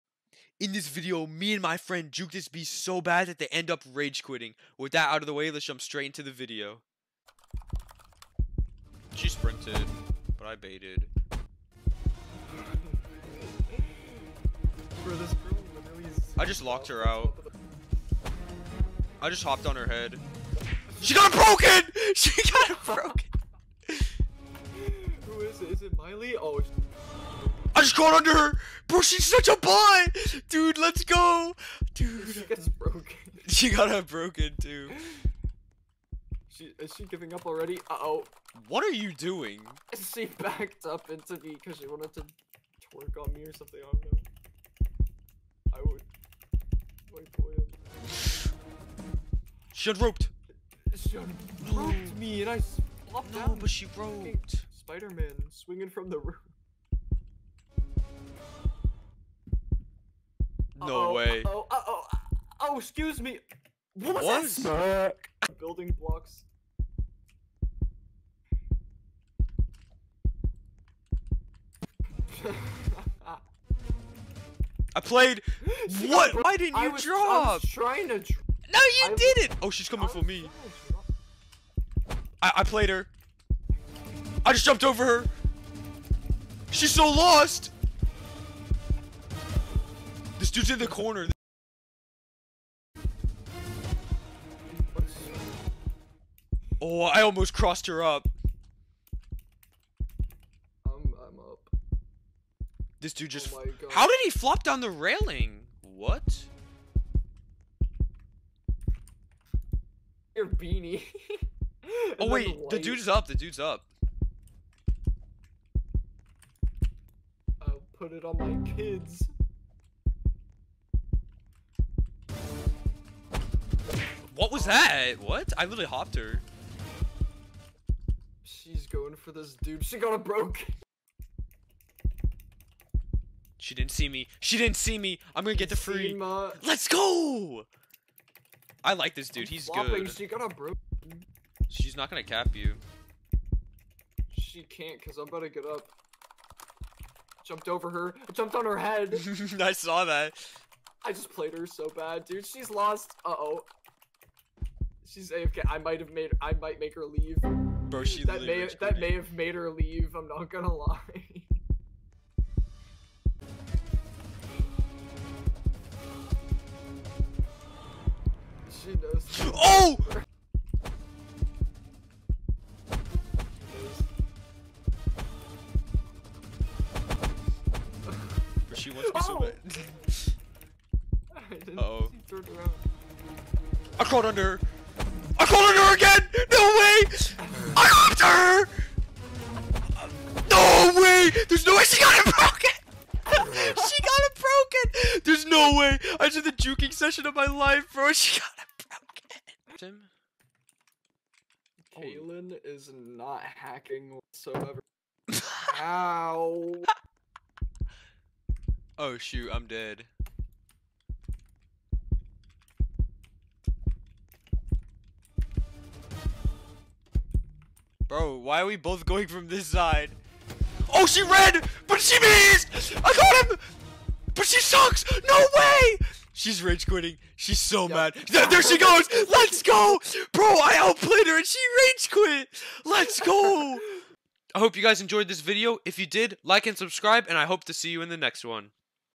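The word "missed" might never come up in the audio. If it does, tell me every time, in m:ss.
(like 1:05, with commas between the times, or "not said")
3:42.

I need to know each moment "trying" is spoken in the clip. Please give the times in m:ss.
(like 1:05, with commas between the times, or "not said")
1:17.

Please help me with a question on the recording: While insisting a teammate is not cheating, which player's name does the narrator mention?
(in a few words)
Kaylin.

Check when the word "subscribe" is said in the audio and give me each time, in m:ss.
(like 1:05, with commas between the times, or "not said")
3:56.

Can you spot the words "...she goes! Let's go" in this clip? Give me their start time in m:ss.
3:48.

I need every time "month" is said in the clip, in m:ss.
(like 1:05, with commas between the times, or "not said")
not said.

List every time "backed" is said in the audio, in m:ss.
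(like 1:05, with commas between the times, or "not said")
0:40.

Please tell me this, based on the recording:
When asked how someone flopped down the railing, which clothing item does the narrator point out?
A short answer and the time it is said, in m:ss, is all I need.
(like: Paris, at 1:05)
Your beanie, at 1:50.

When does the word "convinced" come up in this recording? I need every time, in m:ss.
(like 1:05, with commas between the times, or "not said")
not said.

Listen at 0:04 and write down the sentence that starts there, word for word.
With that out of the way, let's jump straight into the video.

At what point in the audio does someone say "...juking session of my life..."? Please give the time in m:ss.
3:16.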